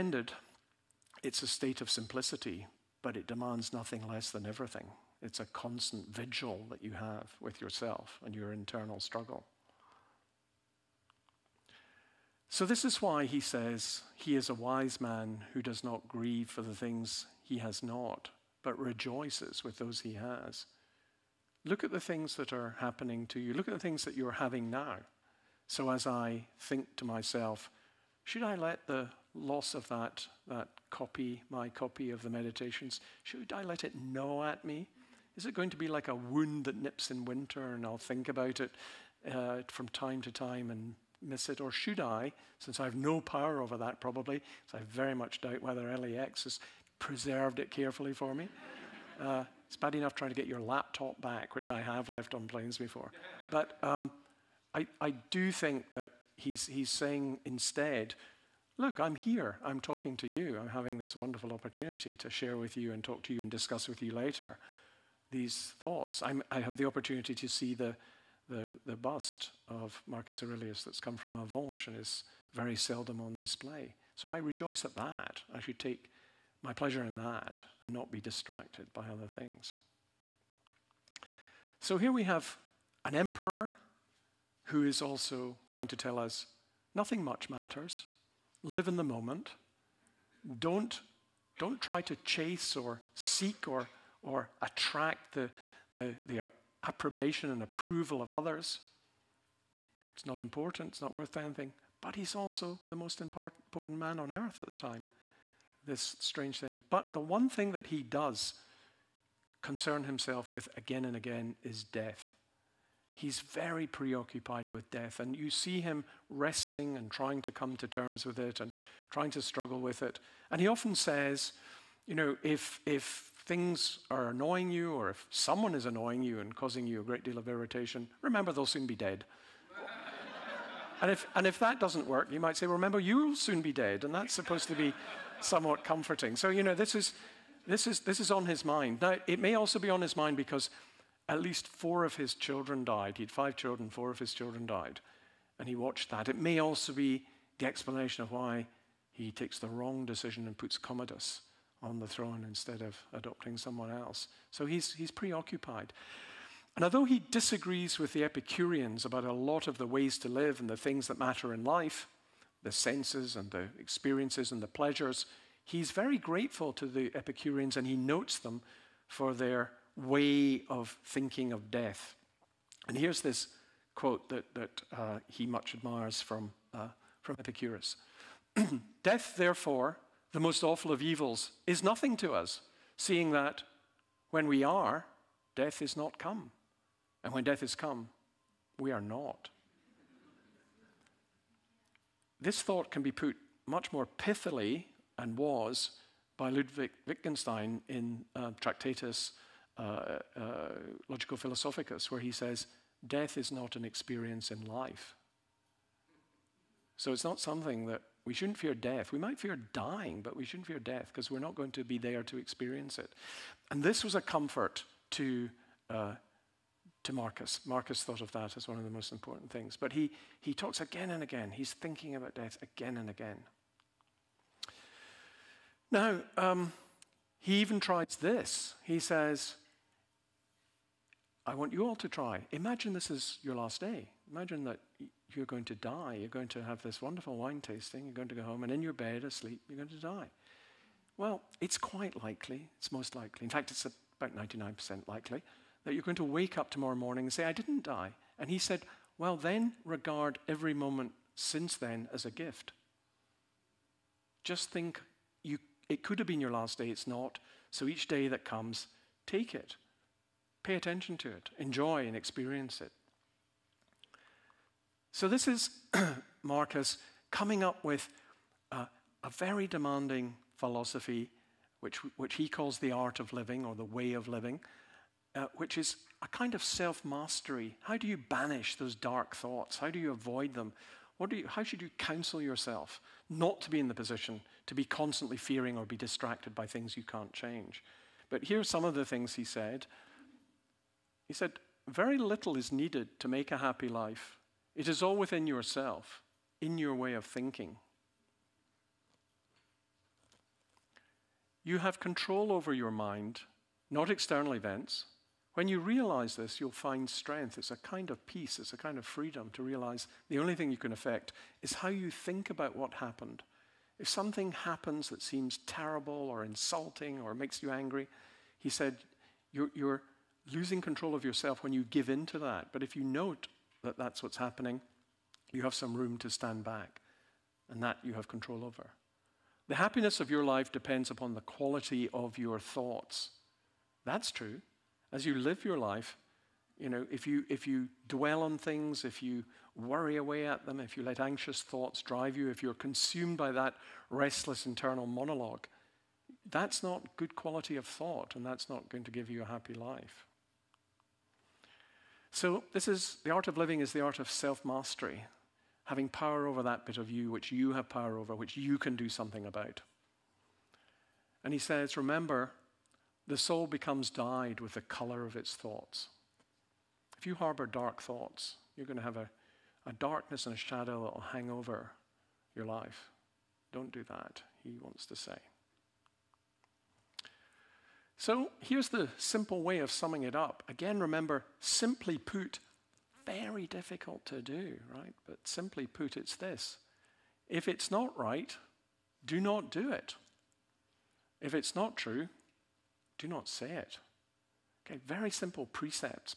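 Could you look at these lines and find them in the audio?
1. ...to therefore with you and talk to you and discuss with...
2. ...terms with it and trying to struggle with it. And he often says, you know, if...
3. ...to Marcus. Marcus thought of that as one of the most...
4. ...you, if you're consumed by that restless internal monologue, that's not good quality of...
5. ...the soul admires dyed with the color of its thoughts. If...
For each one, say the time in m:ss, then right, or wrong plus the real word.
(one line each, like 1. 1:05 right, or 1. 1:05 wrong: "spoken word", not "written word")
1. 1:02 wrong: "share", not "therefore"
2. 1:57 right
3. 3:37 right
4. 5:42 right
5. 6:03 wrong: "becomes", not "admires".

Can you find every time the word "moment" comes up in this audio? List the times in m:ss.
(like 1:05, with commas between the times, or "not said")
1:29, 4:10.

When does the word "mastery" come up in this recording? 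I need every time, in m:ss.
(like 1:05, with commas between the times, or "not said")
4:37, 5:54.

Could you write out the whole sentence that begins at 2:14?
And that's supposed to be somewhat comforting.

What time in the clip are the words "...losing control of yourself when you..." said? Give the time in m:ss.
5:20.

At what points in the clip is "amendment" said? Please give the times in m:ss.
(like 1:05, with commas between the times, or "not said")
not said.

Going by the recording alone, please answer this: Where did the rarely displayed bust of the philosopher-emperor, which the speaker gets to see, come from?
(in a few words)
Avenches.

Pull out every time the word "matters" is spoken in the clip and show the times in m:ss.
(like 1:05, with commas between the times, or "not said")
1:27, 2:41.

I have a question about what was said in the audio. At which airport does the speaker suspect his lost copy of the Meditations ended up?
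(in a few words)
LAX.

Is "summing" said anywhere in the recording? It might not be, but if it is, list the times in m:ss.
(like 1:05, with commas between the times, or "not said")
6:19.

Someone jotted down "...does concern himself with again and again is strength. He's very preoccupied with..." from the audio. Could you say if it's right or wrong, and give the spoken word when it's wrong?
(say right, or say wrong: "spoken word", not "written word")
wrong: "death", not "strength".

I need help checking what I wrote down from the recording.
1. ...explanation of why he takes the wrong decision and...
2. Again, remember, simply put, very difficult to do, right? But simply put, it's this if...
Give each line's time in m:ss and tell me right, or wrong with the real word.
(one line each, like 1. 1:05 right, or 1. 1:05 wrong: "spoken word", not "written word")
1. 2:27 right
2. 6:20 right.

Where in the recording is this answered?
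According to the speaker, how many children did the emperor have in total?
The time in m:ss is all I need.
2:23.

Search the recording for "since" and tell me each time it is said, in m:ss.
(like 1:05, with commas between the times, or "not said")
0:42, 4:11.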